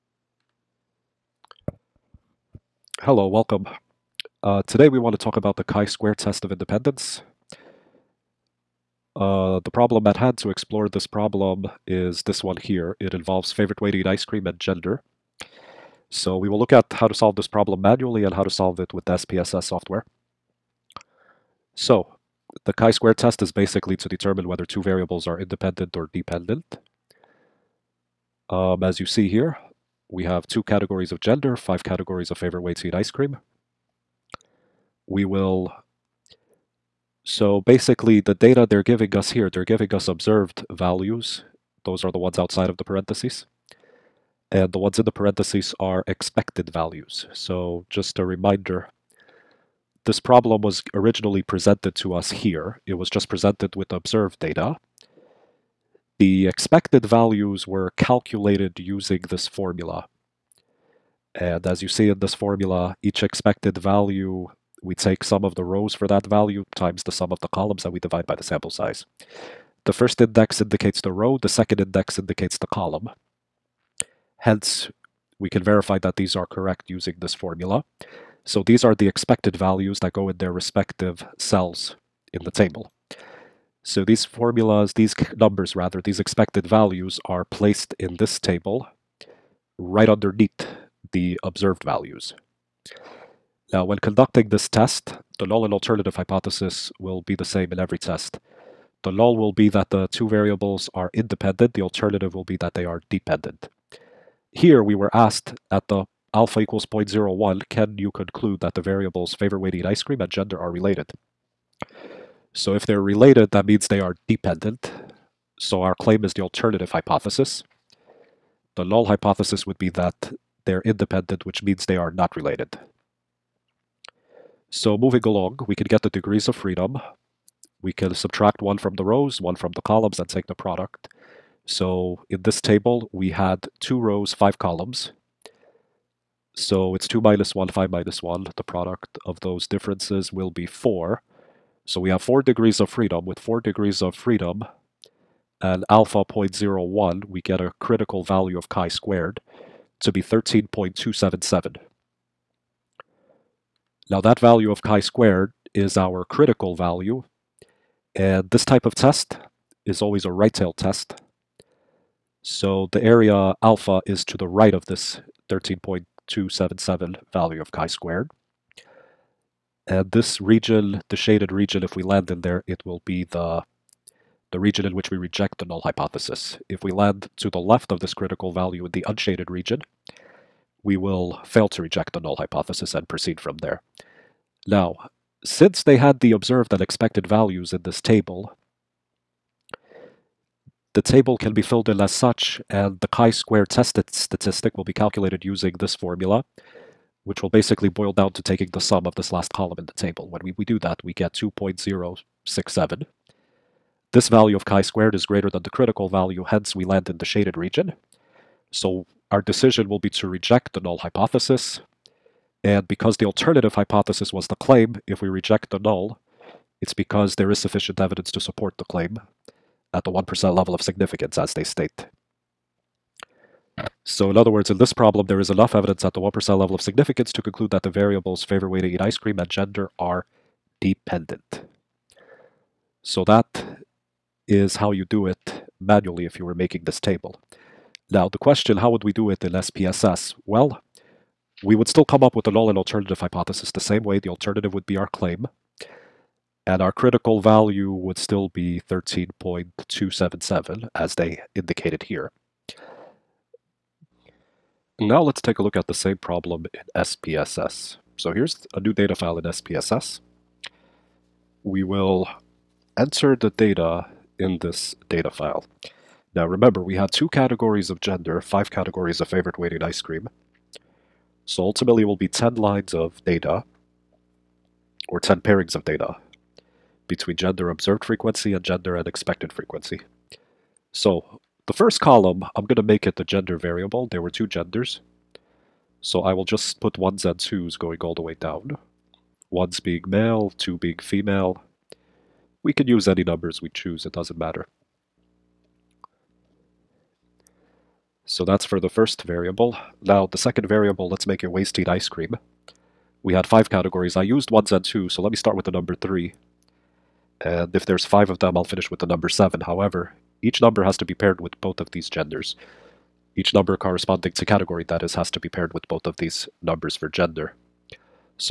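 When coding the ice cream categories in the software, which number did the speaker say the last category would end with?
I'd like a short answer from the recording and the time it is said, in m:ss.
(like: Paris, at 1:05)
7, at 5:08.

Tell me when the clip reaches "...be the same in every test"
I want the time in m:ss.
1:37.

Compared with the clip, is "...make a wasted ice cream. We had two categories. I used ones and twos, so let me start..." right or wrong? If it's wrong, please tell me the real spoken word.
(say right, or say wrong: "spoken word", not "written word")
wrong: "five", not "two".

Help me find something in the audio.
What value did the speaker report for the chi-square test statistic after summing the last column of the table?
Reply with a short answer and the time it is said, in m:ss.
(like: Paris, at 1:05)
2.067, at 3:21.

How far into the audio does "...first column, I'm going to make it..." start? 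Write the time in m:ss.
4:41.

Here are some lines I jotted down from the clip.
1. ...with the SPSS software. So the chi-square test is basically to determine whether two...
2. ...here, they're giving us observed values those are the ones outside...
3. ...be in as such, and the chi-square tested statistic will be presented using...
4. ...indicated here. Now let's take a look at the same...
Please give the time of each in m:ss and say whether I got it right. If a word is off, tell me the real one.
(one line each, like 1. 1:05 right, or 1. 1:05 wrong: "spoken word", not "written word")
1. 0:18 right
2. 0:39 right
3. 3:11 wrong: "calculated", not "presented"
4. 4:11 right.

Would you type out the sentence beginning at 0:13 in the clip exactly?
It involves favorite way to eat ice cream and gender.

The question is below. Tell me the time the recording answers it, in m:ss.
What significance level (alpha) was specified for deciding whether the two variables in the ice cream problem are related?
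1:46.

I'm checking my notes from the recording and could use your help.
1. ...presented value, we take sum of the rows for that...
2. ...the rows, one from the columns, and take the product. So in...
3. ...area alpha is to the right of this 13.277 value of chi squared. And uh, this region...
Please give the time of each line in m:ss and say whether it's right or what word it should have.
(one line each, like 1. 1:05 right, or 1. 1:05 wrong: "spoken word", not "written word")
1. 1:03 wrong: "expected", not "presented"
2. 2:08 right
3. 2:43 right.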